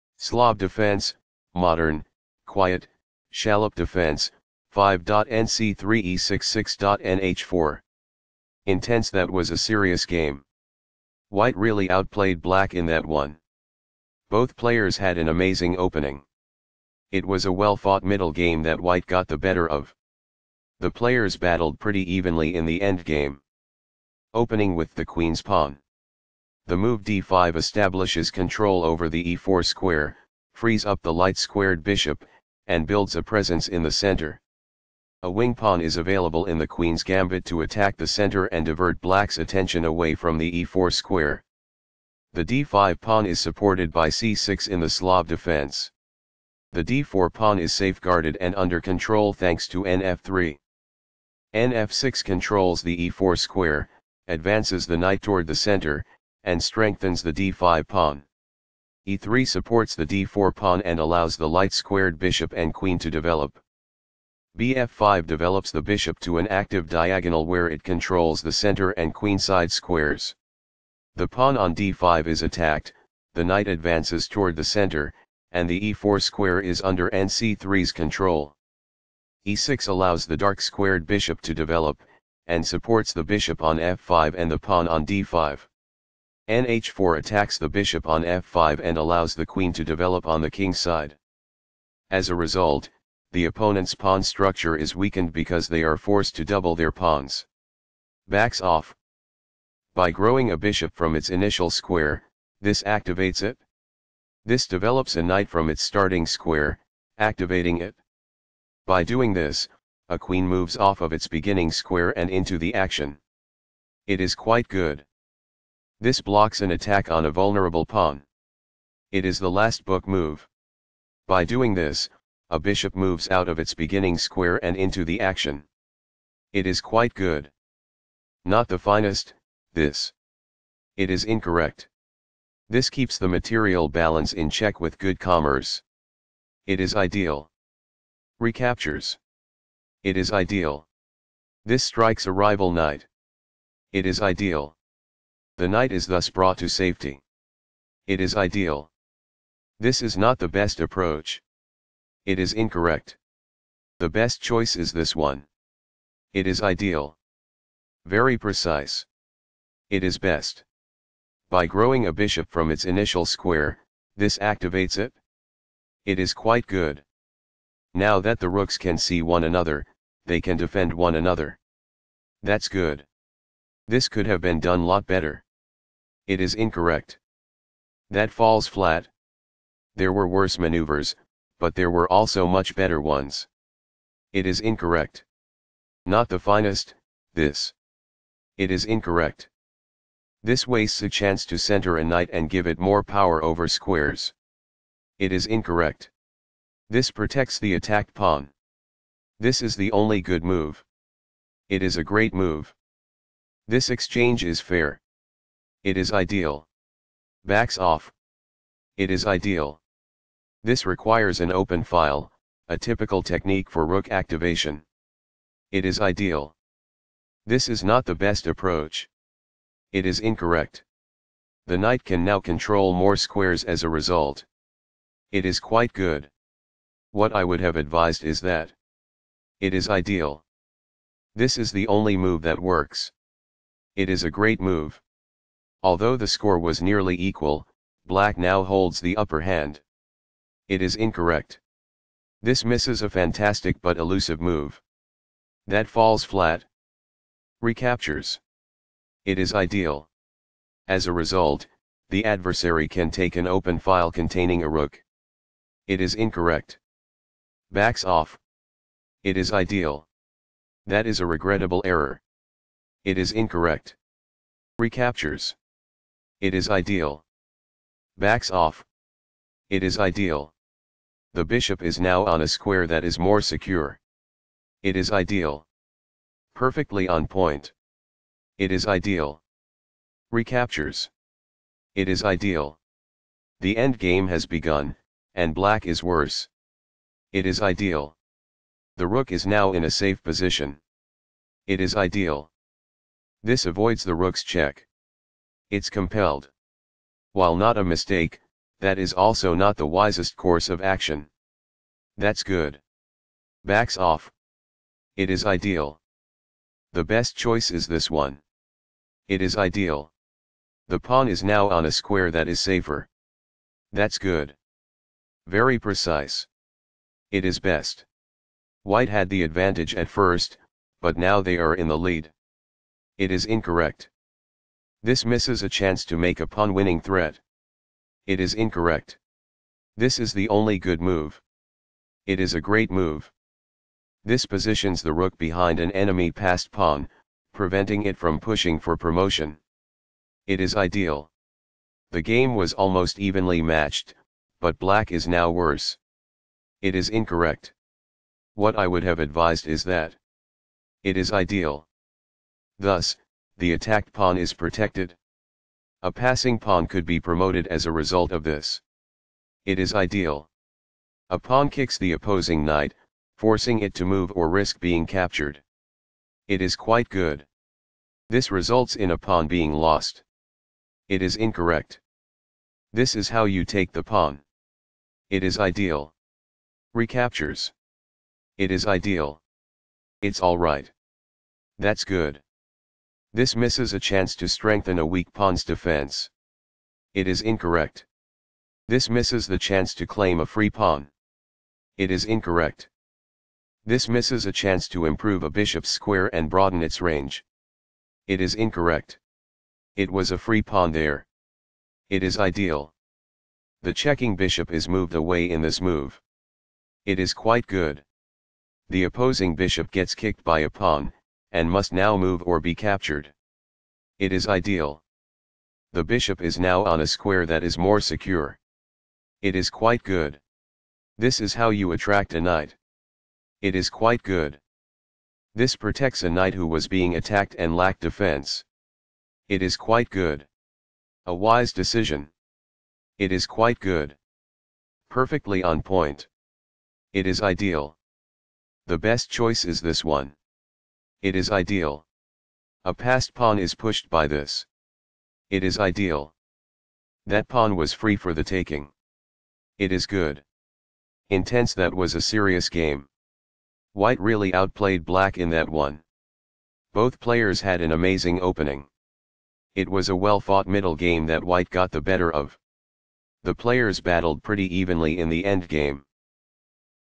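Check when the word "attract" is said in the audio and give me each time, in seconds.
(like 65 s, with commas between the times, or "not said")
421 s.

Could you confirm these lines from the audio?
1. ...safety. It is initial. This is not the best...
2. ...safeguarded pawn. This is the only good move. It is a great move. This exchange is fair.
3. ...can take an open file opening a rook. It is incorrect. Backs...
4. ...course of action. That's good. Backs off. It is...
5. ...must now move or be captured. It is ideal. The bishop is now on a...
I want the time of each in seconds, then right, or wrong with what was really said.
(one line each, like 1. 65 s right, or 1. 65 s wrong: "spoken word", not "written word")
1. 146 s wrong: "ideal", not "initial"
2. 197 s wrong: "attacked", not "safeguarded"
3. 252 s wrong: "containing", not "opening"
4. 300 s right
5. 411 s right.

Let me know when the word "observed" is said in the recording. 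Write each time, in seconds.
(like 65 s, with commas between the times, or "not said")
not said.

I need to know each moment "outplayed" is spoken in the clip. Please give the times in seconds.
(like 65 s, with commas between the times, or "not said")
11 s, 454 s.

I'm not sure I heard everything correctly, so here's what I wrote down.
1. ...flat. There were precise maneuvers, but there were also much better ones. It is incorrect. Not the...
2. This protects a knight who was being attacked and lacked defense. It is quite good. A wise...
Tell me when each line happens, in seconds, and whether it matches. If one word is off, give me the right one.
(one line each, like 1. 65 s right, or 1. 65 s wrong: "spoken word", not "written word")
1. 178 s wrong: "worse", not "precise"
2. 425 s right.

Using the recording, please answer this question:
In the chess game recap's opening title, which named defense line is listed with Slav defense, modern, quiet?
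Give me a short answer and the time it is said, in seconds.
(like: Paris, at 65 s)
Schallopp defense, at 3 s.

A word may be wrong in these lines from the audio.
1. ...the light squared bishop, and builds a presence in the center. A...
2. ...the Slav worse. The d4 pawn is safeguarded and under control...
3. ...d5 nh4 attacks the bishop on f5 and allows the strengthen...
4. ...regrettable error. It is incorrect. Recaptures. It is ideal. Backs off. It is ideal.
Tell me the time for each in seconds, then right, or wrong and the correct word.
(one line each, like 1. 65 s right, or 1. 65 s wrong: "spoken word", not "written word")
1. 31 s right
2. 44 s wrong: "defense", not "worse"
3. 85 s wrong: "queen", not "strengthen"
4. 261 s right.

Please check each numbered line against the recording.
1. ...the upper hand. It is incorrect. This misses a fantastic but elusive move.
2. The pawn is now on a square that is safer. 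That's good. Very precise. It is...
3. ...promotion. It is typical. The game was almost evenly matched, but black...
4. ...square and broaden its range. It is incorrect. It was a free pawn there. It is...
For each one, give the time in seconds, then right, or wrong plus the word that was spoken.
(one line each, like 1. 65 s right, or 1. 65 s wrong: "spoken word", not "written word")
1. 239 s right
2. 310 s right
3. 338 s wrong: "ideal", not "typical"
4. 395 s right.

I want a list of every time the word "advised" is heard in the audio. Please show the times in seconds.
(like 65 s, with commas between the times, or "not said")
227 s, 349 s.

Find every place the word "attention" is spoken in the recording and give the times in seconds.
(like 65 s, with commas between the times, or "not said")
39 s.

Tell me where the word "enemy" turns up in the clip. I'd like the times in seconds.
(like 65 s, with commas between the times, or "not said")
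335 s.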